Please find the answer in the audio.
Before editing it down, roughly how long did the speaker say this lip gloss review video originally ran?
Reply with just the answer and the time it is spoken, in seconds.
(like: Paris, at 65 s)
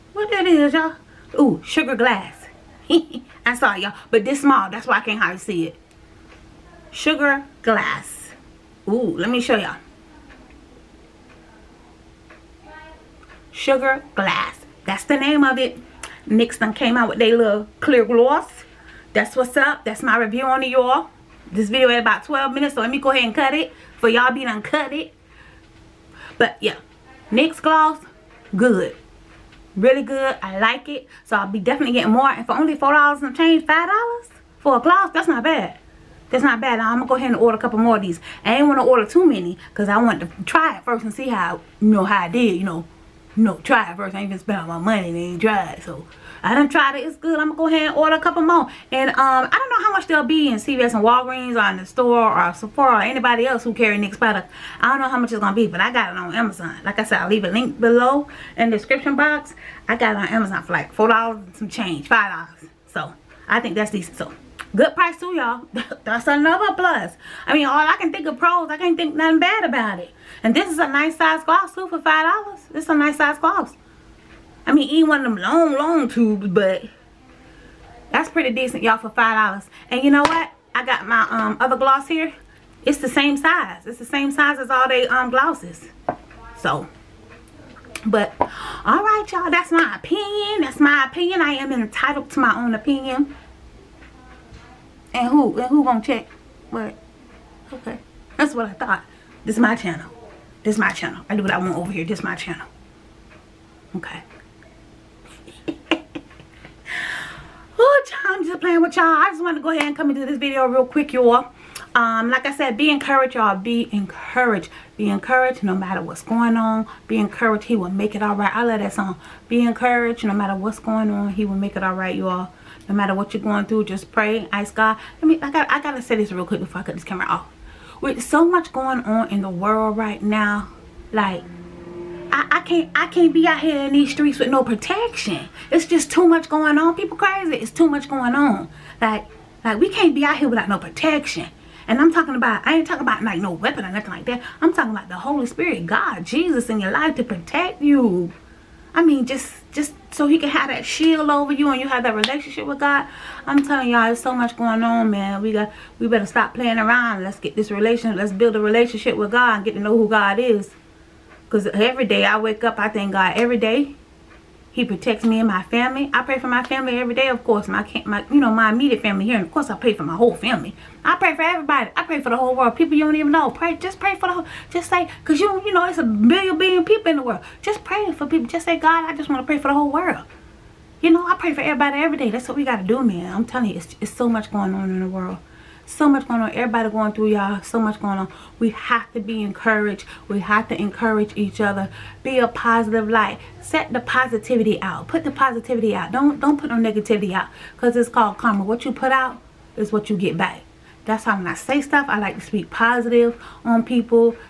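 12 minutes, at 22 s.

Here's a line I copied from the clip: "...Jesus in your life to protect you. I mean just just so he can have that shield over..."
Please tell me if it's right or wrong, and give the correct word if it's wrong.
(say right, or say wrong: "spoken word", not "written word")
right.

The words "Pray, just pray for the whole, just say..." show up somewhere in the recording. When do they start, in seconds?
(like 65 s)
173 s.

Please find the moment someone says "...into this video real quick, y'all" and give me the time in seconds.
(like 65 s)
110 s.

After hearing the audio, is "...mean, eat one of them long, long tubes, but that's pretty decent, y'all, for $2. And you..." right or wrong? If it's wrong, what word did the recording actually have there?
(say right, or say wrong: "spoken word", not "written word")
wrong: "5", not "2".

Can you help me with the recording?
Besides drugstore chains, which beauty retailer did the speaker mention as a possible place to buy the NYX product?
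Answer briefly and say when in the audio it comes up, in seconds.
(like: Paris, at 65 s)
Sephora, at 52 s.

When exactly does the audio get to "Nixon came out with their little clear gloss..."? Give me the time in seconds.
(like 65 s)
16 s.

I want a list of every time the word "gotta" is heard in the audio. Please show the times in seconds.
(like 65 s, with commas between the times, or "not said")
125 s.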